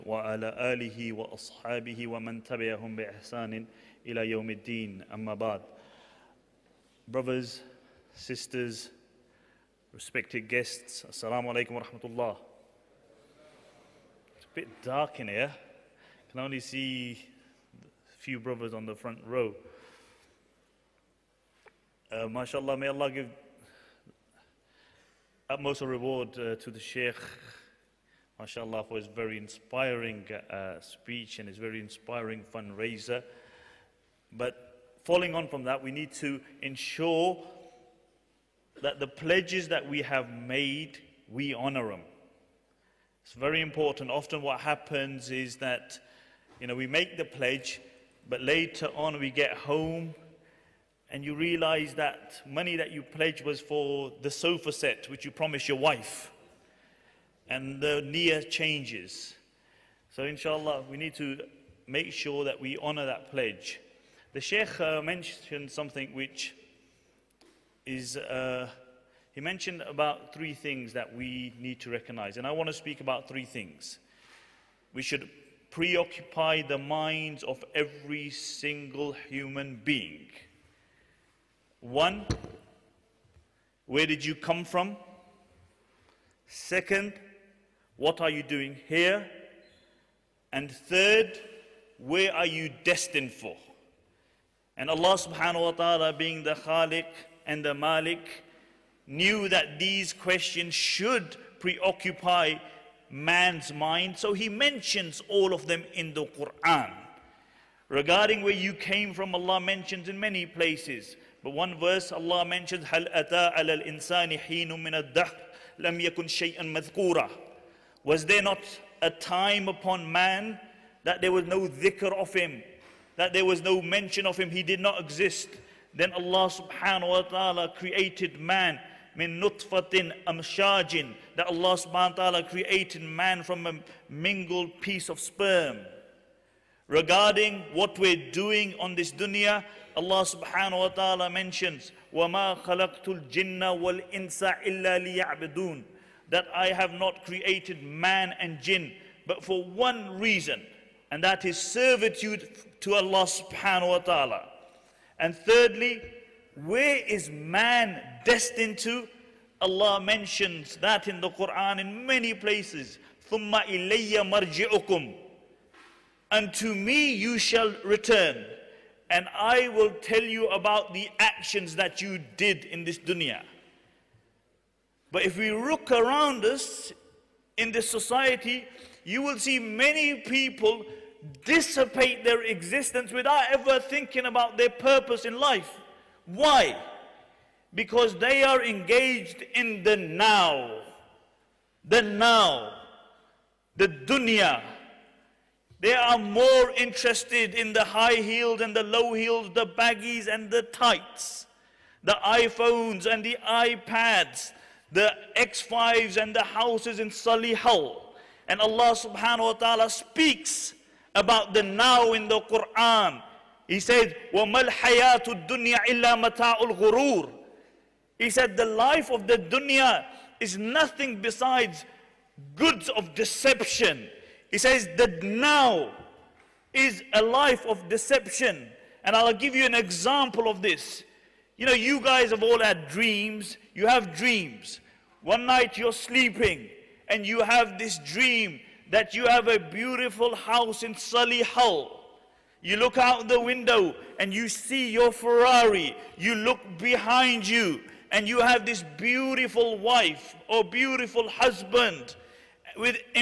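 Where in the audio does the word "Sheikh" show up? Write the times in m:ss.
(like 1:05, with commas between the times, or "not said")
0:26, 1:04.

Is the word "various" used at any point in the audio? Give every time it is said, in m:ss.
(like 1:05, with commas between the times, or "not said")
not said.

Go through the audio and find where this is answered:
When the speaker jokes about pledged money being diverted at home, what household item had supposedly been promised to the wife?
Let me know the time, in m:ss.
0:54.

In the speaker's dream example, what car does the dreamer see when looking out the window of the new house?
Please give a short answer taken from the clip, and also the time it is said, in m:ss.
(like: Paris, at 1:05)
Ferrari, at 4:05.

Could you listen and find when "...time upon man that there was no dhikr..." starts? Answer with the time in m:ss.
1:59.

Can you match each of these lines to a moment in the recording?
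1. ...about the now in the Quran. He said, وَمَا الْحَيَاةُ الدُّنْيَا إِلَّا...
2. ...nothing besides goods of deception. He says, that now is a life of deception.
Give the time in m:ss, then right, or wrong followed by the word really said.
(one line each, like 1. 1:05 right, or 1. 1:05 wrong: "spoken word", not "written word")
1. 3:31 right
2. 3:40 right.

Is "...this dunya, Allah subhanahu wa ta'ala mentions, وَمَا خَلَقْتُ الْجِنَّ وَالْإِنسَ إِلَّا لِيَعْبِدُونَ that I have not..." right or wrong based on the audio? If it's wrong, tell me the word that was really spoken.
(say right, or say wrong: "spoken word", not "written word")
right.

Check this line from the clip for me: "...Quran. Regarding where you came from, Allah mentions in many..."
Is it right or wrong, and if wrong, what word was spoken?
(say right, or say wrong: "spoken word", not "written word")
right.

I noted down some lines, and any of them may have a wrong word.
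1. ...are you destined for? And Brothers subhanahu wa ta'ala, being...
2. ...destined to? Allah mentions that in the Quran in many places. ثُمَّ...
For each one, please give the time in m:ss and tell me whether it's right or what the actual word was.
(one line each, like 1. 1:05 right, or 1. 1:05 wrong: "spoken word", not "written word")
1. 1:32 wrong: "Allah", not "Brothers"
2. 2:38 right.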